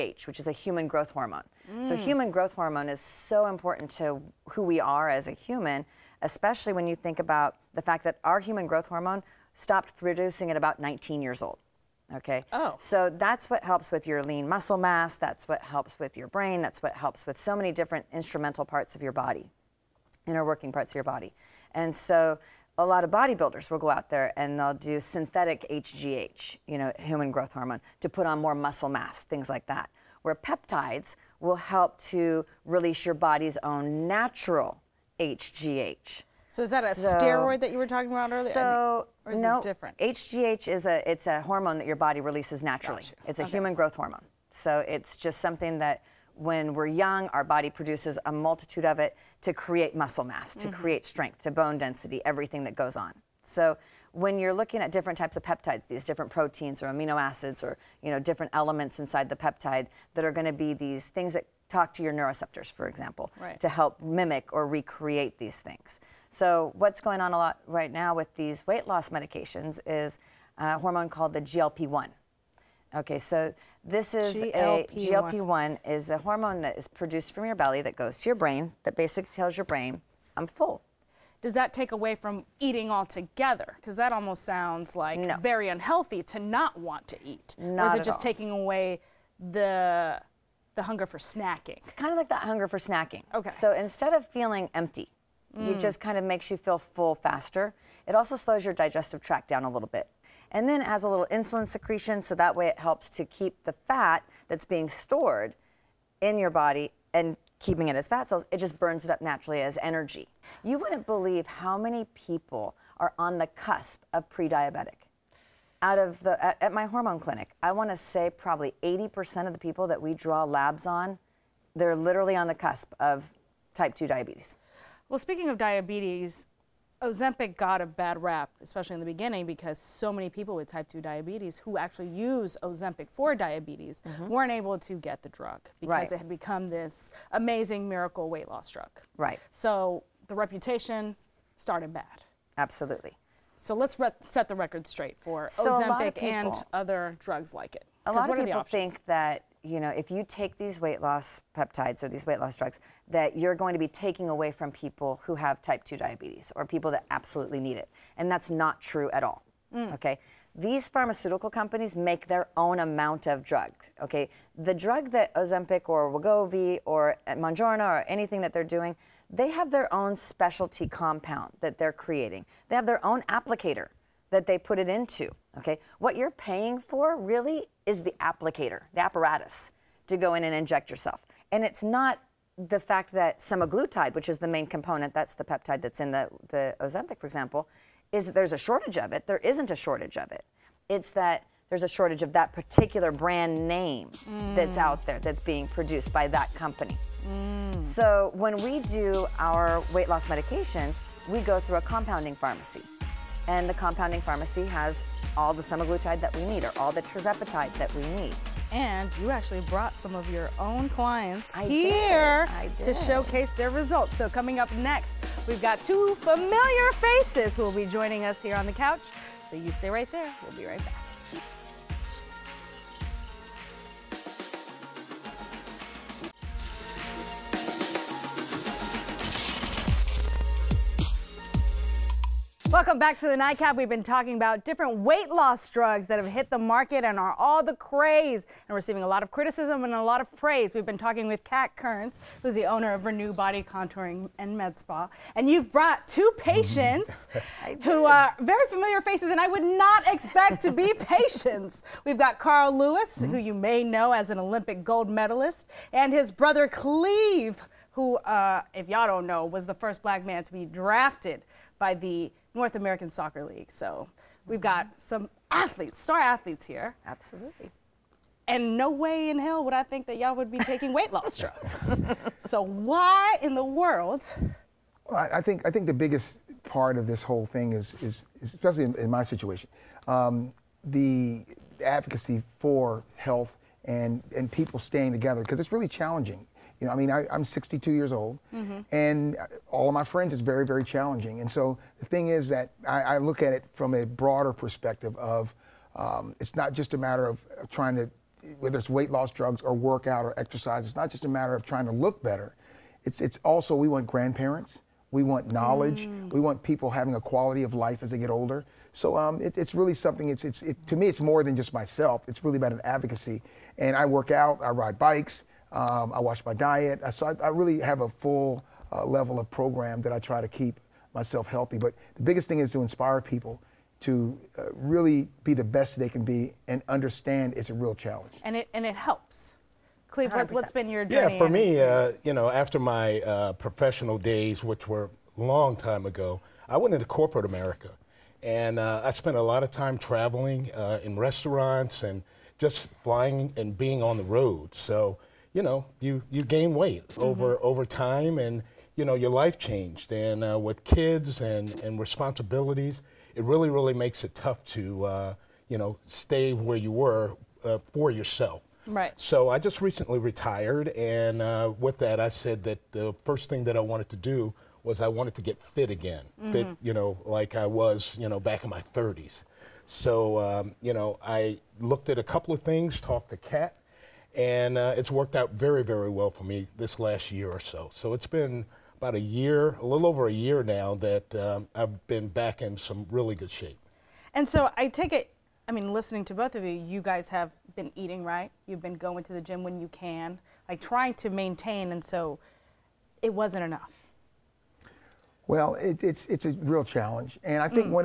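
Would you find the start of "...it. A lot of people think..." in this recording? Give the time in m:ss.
2:27.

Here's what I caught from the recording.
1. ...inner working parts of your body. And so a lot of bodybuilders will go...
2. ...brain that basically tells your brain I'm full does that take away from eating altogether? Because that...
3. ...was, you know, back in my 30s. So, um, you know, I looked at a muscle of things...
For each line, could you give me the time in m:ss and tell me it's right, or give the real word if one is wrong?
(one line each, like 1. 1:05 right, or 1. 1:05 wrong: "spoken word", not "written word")
1. 0:20 right
2. 1:18 right
3. 6:07 wrong: "couple", not "muscle".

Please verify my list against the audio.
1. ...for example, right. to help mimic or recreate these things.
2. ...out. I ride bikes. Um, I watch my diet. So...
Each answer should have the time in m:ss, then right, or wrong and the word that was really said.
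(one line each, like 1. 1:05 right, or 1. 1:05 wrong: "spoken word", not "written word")
1. 1:02 right
2. 5:14 right.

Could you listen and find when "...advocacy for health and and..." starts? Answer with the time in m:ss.
4:41.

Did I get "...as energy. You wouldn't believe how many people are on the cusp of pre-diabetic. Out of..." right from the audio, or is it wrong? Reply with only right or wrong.
right.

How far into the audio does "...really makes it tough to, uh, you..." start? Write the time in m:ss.
5:53.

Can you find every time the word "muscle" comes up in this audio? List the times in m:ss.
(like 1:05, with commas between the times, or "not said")
0:14, 0:28, 0:49.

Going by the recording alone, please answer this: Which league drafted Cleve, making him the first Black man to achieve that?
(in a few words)
North American Soccer League.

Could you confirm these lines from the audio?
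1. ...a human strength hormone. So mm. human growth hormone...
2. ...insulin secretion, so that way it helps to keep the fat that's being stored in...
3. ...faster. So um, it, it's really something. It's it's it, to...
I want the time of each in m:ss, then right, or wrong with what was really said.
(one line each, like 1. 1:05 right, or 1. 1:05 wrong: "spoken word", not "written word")
1. 0:00 wrong: "growth", not "strength"
2. 1:41 right
3. 5:08 wrong: "older", not "faster".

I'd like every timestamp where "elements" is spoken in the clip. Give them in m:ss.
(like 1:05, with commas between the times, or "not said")
0:58.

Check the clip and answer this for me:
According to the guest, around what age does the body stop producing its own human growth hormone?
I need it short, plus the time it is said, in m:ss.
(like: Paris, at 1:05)
19, at 0:10.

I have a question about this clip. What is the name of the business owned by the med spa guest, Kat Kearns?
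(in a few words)
Renew Body Contouring and Med Spa.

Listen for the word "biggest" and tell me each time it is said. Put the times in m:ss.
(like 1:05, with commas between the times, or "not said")
4:35, 5:22.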